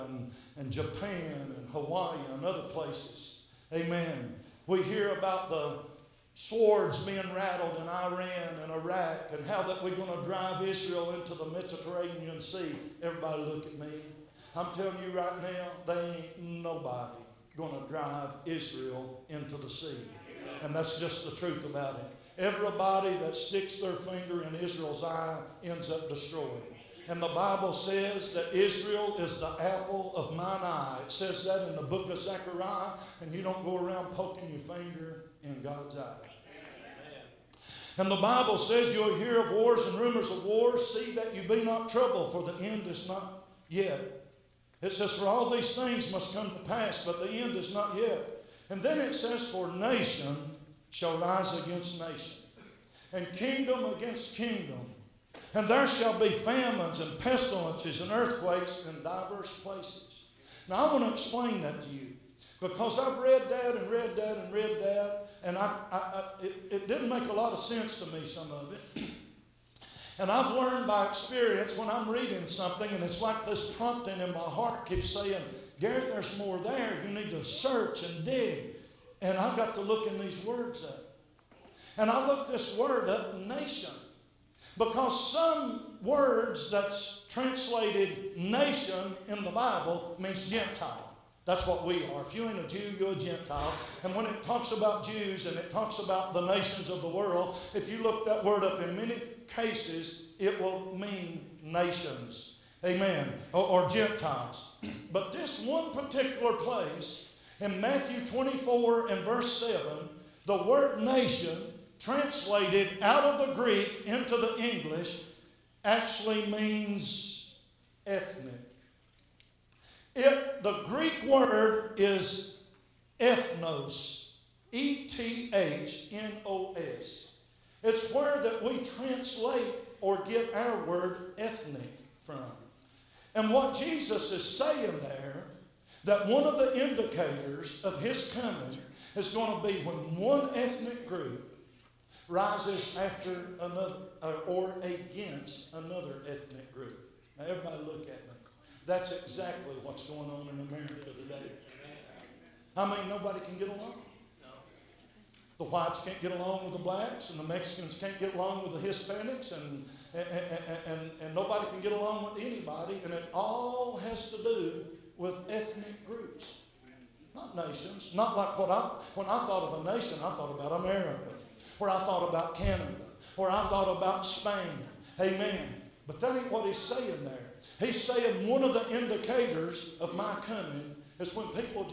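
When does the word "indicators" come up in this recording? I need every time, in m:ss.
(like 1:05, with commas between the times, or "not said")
2:16, 2:58.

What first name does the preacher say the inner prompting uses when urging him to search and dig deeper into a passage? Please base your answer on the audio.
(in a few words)
Gary.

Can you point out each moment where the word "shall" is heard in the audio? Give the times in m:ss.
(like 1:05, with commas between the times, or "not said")
0:50, 0:55.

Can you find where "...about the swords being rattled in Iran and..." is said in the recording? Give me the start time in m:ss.
0:05.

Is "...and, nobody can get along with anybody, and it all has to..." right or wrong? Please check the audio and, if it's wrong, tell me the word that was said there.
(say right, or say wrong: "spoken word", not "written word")
right.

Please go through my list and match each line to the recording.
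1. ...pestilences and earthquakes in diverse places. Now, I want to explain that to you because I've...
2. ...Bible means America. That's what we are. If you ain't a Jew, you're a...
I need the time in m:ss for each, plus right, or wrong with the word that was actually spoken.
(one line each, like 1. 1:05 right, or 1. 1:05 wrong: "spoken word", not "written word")
1. 0:57 right
2. 1:29 wrong: "Gentile", not "America".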